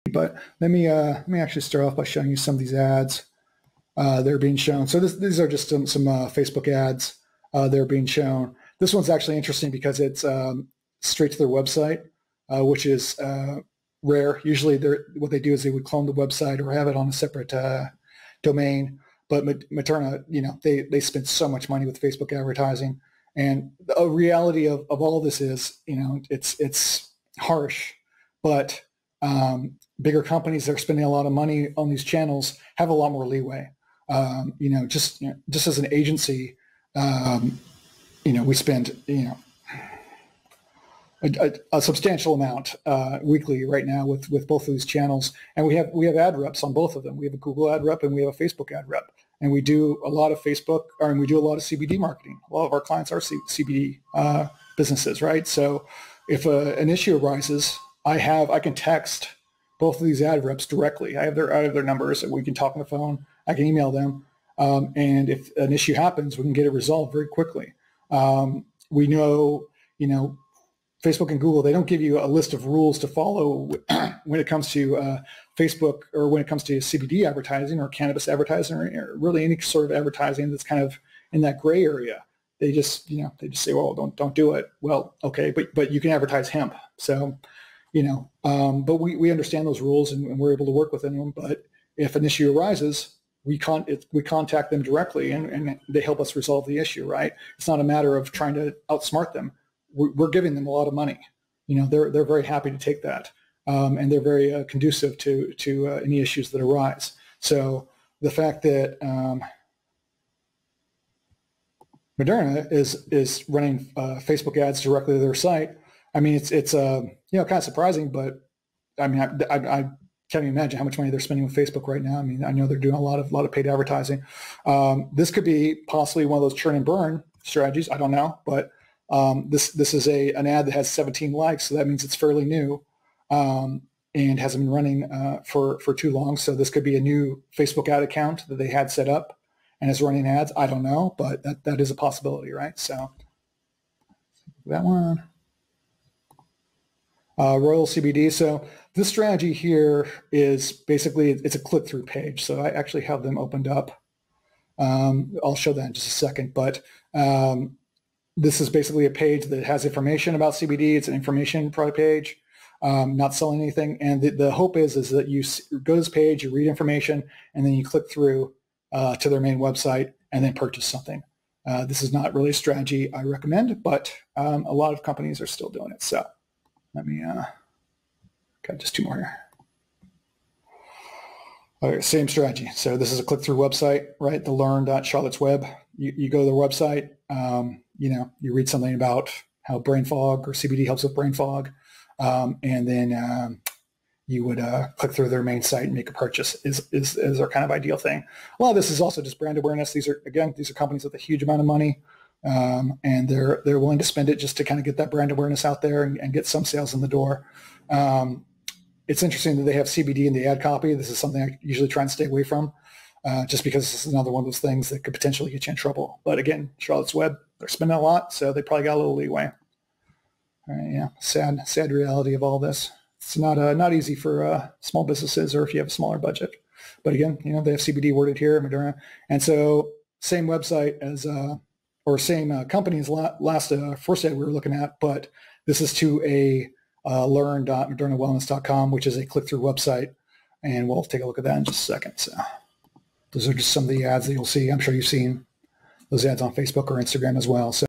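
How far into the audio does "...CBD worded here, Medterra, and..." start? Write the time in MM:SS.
03:47.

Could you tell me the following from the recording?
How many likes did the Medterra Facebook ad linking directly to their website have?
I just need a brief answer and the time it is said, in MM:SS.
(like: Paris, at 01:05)
17, at 02:10.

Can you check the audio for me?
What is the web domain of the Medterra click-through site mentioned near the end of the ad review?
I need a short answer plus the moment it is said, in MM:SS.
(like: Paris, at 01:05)
learn.modernawellness.com, at 03:57.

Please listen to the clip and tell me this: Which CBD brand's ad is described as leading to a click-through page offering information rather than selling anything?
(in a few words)
Royal CBD.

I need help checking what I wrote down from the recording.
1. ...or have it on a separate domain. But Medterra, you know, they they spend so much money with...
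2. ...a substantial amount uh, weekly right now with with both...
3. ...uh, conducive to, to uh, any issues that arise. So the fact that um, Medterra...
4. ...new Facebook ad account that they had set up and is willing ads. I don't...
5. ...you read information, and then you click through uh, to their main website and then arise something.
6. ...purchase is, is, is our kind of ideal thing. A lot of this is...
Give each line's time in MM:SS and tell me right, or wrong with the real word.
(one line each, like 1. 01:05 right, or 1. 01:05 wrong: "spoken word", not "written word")
1. 00:16 right
2. 00:41 right
3. 01:44 right
4. 02:17 wrong: "running", not "willing"
5. 02:46 wrong: "purchase", not "arise"
6. 03:16 right.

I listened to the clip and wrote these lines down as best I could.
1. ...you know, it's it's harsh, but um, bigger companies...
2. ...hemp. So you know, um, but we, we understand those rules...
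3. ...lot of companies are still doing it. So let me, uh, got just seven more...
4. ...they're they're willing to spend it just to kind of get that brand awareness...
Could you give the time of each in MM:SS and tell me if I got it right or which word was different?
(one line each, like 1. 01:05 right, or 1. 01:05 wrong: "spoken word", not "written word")
1. 00:25 right
2. 01:26 right
3. 02:54 wrong: "two", not "seven"
4. 03:23 right.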